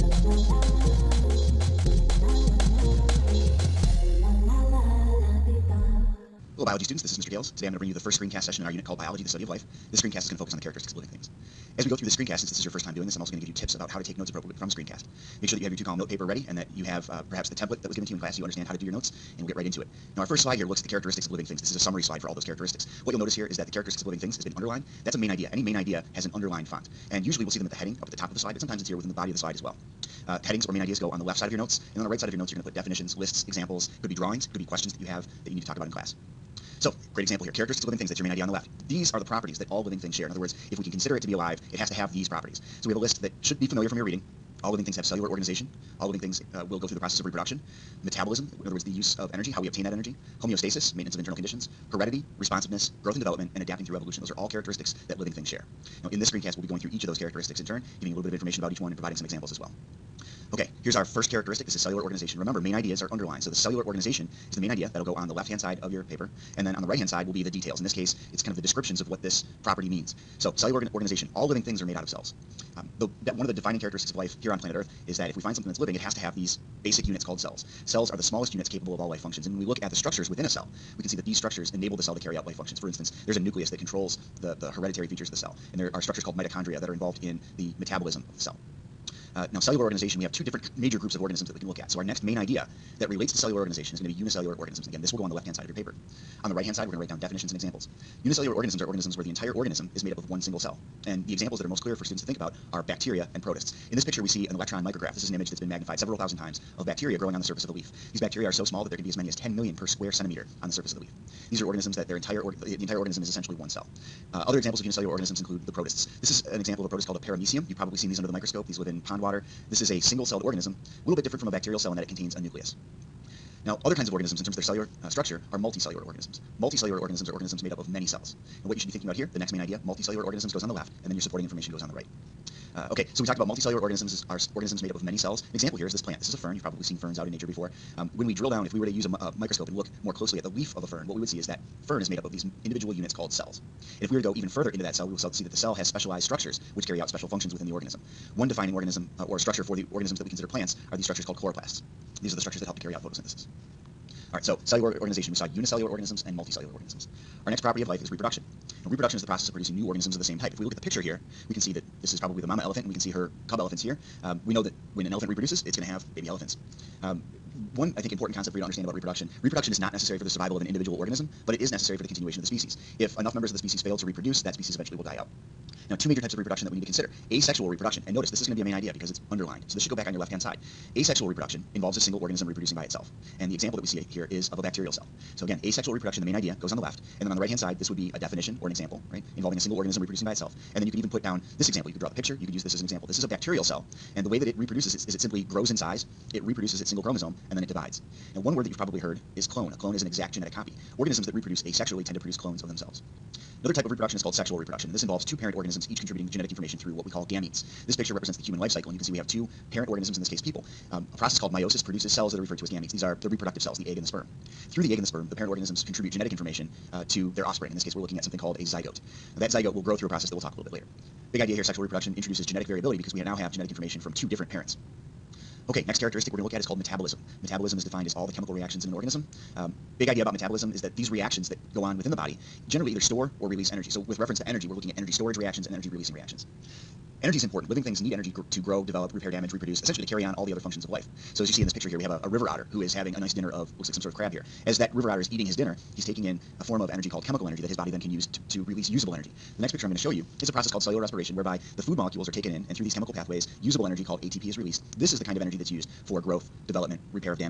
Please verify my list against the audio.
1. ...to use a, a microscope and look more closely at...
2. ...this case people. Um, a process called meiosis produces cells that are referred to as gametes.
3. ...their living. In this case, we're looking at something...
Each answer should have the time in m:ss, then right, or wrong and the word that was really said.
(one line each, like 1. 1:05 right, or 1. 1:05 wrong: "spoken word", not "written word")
1. 2:18 right
2. 3:30 right
3. 3:37 wrong: "offspring", not "living".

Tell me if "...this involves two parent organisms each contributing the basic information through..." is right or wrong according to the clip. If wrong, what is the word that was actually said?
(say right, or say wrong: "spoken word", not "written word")
wrong: "genetic", not "basic".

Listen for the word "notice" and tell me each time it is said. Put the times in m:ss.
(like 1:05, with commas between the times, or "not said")
0:23, 2:58.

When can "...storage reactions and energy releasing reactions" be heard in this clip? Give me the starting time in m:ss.
3:55.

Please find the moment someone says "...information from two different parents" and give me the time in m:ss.
3:43.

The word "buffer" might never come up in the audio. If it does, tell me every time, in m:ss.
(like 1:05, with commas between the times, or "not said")
not said.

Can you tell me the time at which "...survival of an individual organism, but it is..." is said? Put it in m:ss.
2:50.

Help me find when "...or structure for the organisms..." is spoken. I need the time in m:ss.
2:29.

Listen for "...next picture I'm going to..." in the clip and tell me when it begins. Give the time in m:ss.
4:09.